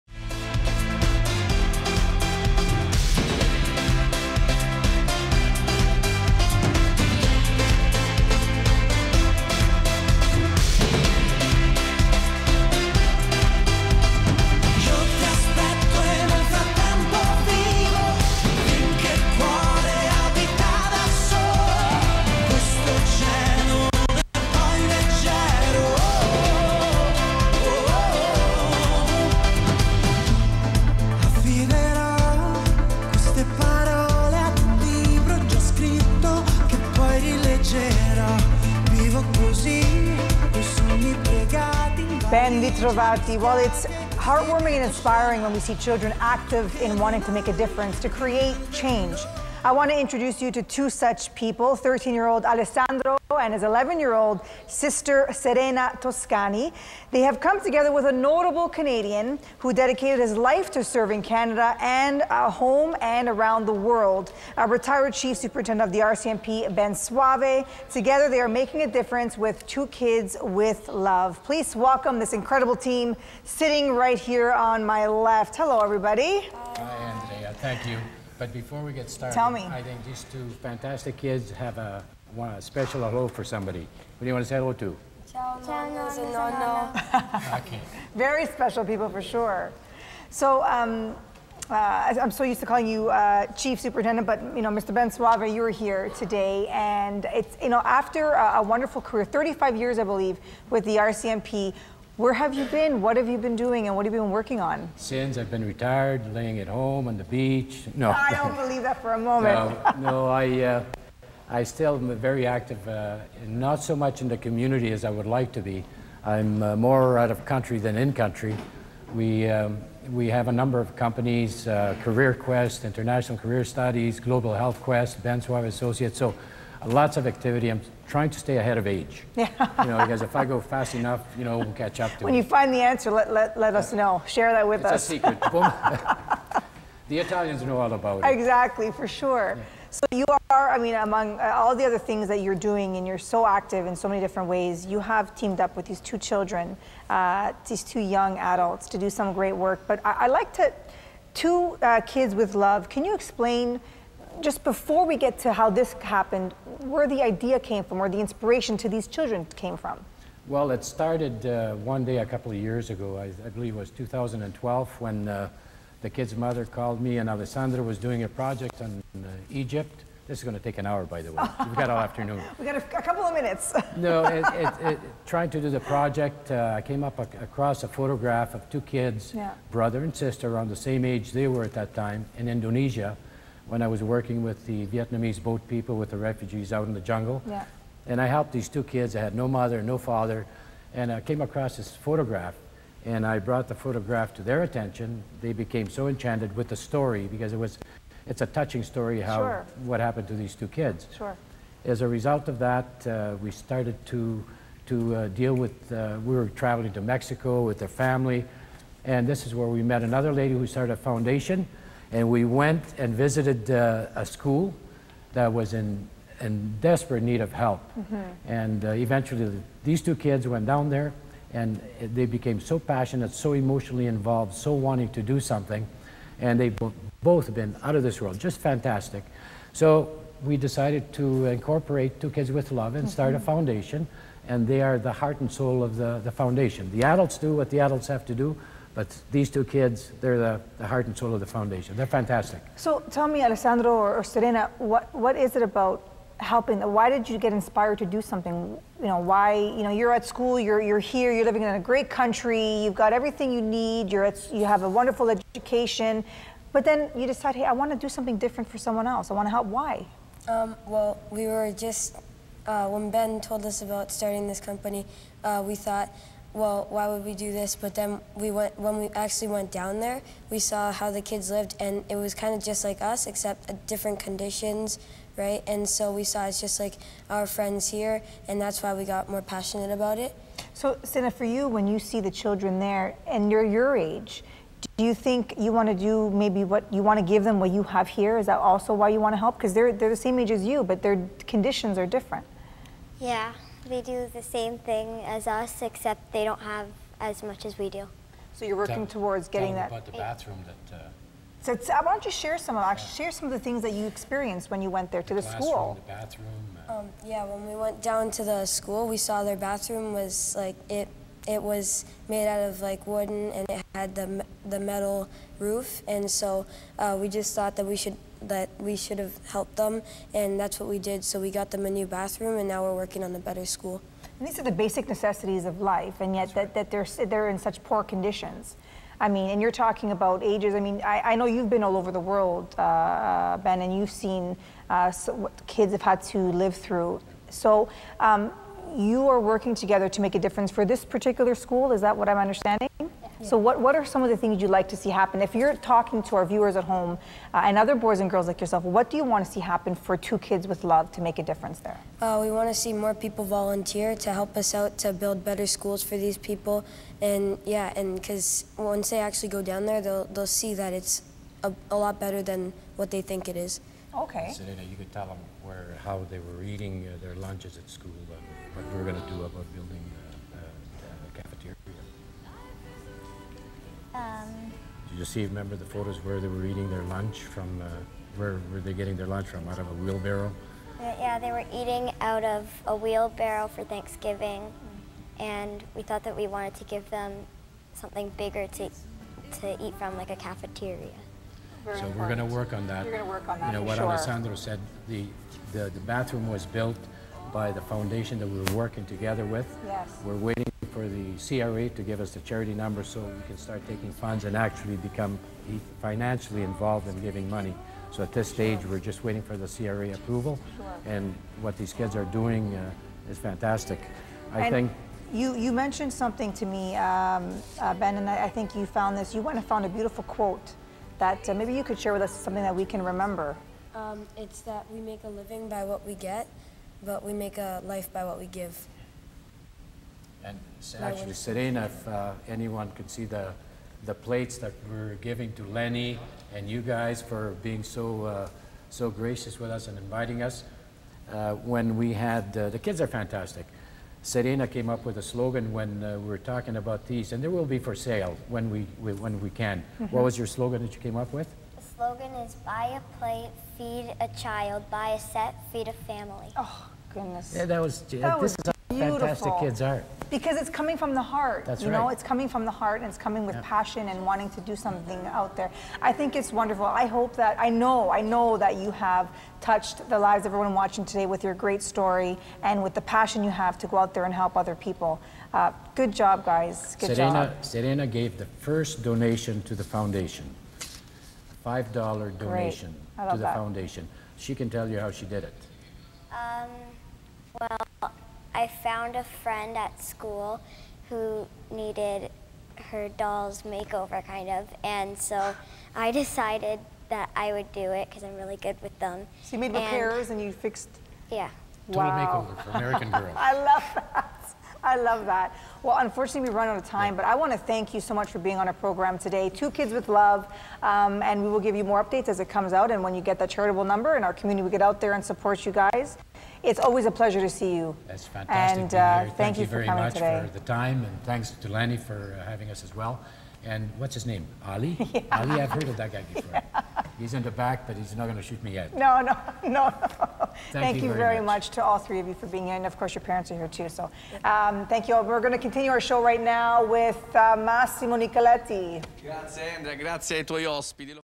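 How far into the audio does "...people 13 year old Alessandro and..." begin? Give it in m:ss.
0:51.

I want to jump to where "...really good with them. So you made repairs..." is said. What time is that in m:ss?
8:18.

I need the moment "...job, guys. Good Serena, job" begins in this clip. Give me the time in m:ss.
7:56.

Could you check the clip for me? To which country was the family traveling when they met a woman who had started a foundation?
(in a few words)
Mexico.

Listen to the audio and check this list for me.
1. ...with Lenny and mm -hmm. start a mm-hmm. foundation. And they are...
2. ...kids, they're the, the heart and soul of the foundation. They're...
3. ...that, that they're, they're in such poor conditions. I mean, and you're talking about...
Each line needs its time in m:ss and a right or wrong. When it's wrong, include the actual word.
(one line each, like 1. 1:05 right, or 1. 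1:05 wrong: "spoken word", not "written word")
1. 3:52 wrong: "Love", not "Lenny"
2. 3:59 right
3. 5:26 right.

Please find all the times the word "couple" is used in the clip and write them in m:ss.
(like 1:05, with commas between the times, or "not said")
2:42, 2:53.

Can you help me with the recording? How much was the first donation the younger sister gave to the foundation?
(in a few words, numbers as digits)
$5.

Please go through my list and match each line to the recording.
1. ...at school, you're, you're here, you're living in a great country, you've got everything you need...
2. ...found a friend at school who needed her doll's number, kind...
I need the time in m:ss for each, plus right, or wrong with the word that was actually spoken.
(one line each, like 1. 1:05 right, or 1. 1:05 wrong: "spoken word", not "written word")
1. 4:10 right
2. 8:08 wrong: "makeover", not "number".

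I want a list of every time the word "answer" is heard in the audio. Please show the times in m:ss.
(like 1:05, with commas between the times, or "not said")
2:12.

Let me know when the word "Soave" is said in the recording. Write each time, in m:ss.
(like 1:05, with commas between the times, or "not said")
1:06, 1:35, 2:05.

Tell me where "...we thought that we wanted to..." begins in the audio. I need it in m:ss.
6:25.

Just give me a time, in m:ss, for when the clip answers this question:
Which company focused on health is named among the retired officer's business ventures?
2:04.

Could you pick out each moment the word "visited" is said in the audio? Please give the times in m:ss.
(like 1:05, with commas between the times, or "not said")
3:33.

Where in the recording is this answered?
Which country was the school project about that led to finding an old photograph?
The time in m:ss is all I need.
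2:49.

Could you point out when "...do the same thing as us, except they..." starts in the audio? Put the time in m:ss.
4:54.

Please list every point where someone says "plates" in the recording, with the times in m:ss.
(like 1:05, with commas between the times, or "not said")
7:14, 7:33.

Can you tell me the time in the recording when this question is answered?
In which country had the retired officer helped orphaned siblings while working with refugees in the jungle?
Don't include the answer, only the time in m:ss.
3:02.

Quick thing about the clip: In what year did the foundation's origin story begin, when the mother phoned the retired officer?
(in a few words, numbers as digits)
2012.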